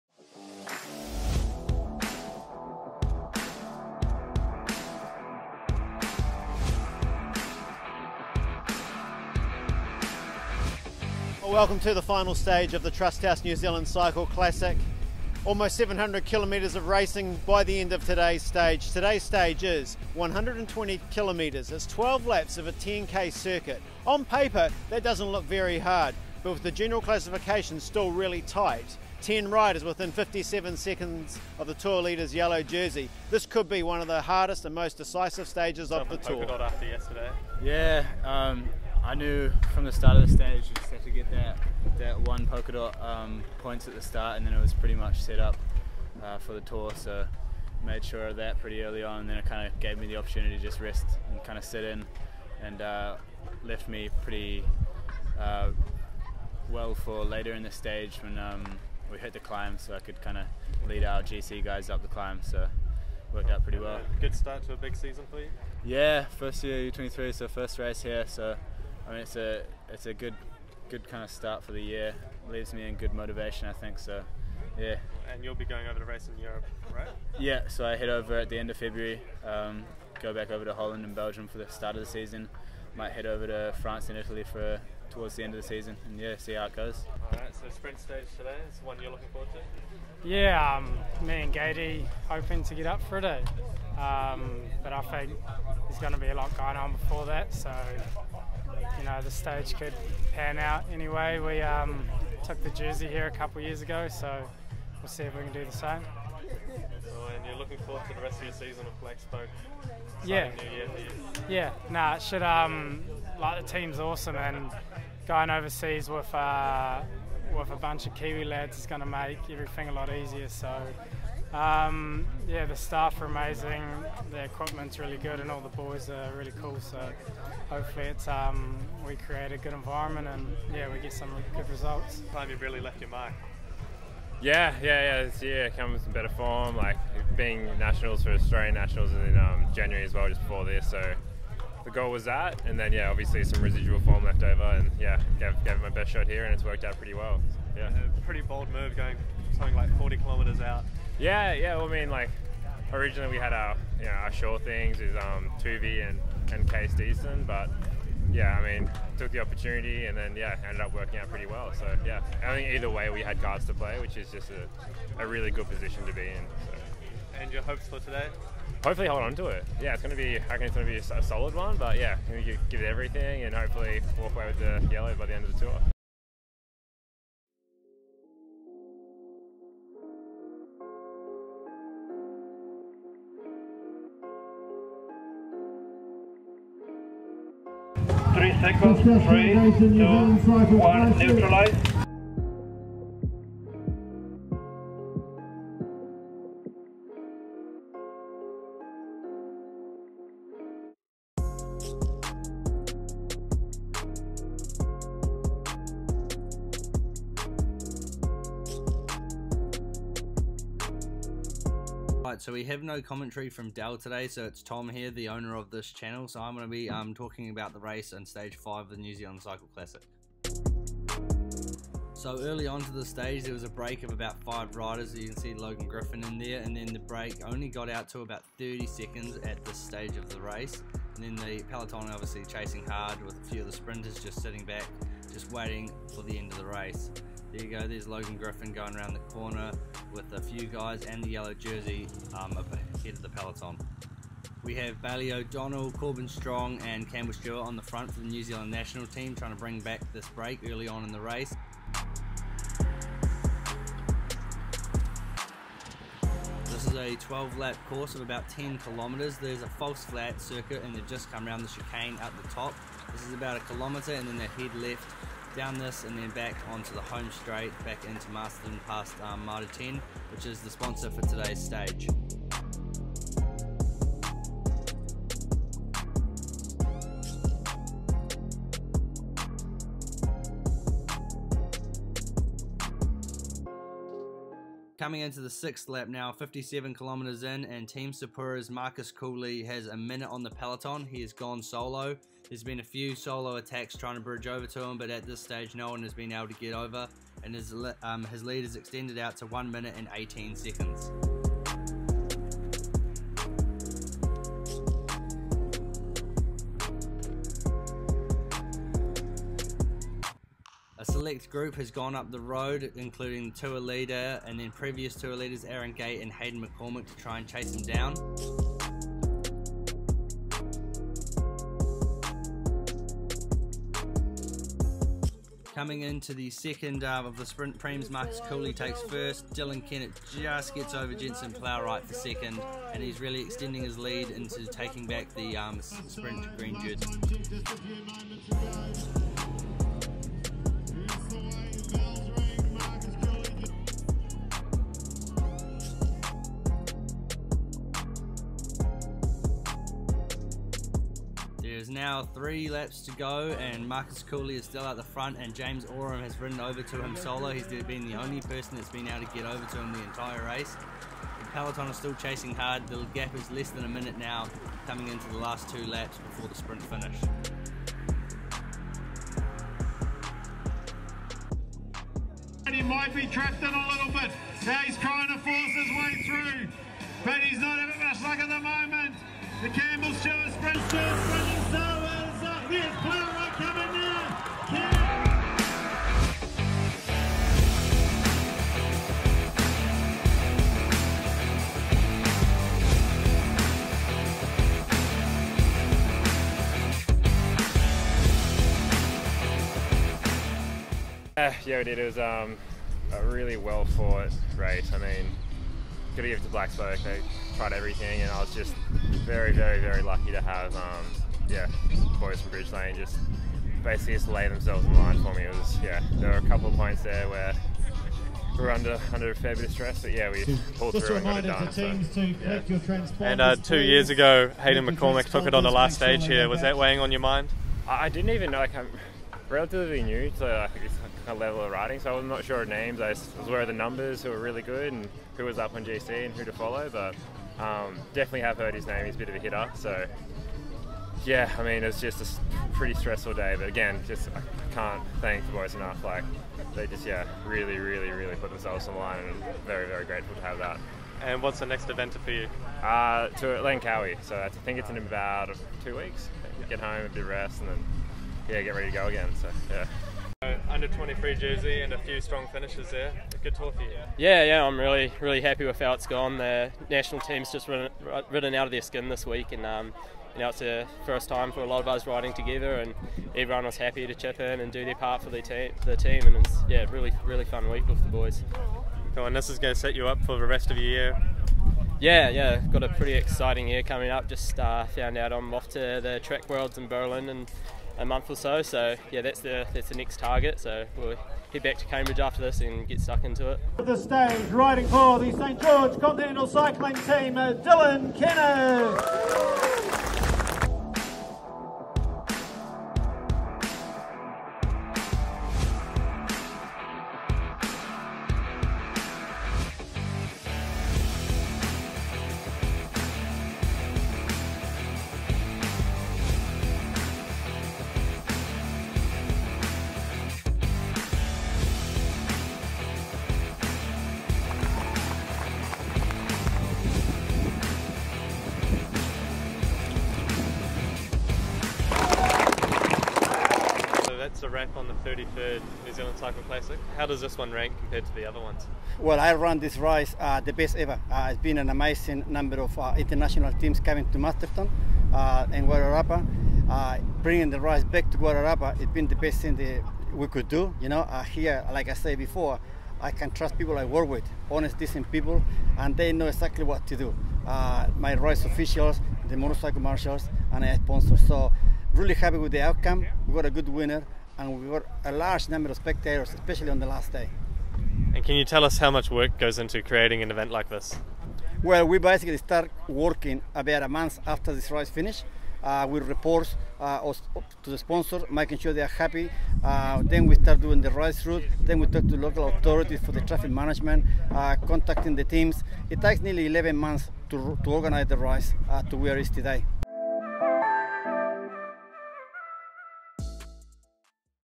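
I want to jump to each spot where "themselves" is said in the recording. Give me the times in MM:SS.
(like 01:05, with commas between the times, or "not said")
06:54, 07:28.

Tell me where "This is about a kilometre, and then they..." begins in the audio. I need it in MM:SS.
04:23.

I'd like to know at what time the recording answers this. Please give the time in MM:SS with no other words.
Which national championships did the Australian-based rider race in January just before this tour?
02:18.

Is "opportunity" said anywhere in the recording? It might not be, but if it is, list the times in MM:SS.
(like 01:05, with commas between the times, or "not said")
00:50, 02:39.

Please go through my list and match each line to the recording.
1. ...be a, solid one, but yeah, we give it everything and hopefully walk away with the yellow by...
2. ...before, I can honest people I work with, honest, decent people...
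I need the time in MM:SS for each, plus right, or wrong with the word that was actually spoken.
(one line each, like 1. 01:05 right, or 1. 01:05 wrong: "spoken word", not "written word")
1. 02:50 right
2. 09:12 wrong: "trust", not "honest".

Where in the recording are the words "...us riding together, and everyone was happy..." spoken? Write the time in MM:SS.
07:51.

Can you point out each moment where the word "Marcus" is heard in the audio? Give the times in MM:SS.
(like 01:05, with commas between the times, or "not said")
04:48, 05:28, 05:53.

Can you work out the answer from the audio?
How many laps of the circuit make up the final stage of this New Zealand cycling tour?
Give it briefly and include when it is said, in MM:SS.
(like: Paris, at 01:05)
12, at 00:21.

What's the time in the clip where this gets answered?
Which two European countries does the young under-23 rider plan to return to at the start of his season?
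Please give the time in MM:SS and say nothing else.
01:20.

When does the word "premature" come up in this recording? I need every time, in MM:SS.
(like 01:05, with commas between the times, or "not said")
not said.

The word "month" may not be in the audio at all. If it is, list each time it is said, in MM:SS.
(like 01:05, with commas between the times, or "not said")
08:08, 09:33, 09:46.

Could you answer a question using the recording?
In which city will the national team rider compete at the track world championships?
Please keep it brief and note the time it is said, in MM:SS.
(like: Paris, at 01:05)
Berlin, at 08:06.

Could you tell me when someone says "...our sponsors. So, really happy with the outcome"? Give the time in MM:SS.
09:20.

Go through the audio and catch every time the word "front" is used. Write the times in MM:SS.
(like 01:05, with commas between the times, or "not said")
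04:07, 05:55.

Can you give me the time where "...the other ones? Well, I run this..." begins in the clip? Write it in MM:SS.
08:58.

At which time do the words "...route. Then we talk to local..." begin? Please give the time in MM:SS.
09:41.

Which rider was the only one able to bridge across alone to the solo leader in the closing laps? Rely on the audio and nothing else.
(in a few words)
James Oram.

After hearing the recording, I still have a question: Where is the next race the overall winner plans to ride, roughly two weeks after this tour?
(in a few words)
Langkawi.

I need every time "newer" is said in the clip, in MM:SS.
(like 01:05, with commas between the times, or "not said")
not said.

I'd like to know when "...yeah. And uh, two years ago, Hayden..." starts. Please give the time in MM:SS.
07:02.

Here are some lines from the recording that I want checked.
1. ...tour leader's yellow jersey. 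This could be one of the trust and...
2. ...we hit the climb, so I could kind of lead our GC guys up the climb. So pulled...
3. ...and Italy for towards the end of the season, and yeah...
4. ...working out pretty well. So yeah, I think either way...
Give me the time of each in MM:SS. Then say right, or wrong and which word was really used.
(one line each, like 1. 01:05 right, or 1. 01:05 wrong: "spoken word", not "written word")
1. 00:31 wrong: "hardest", not "trust"
2. 00:59 wrong: "worked", not "pulled"
3. 01:24 right
4. 02:40 right.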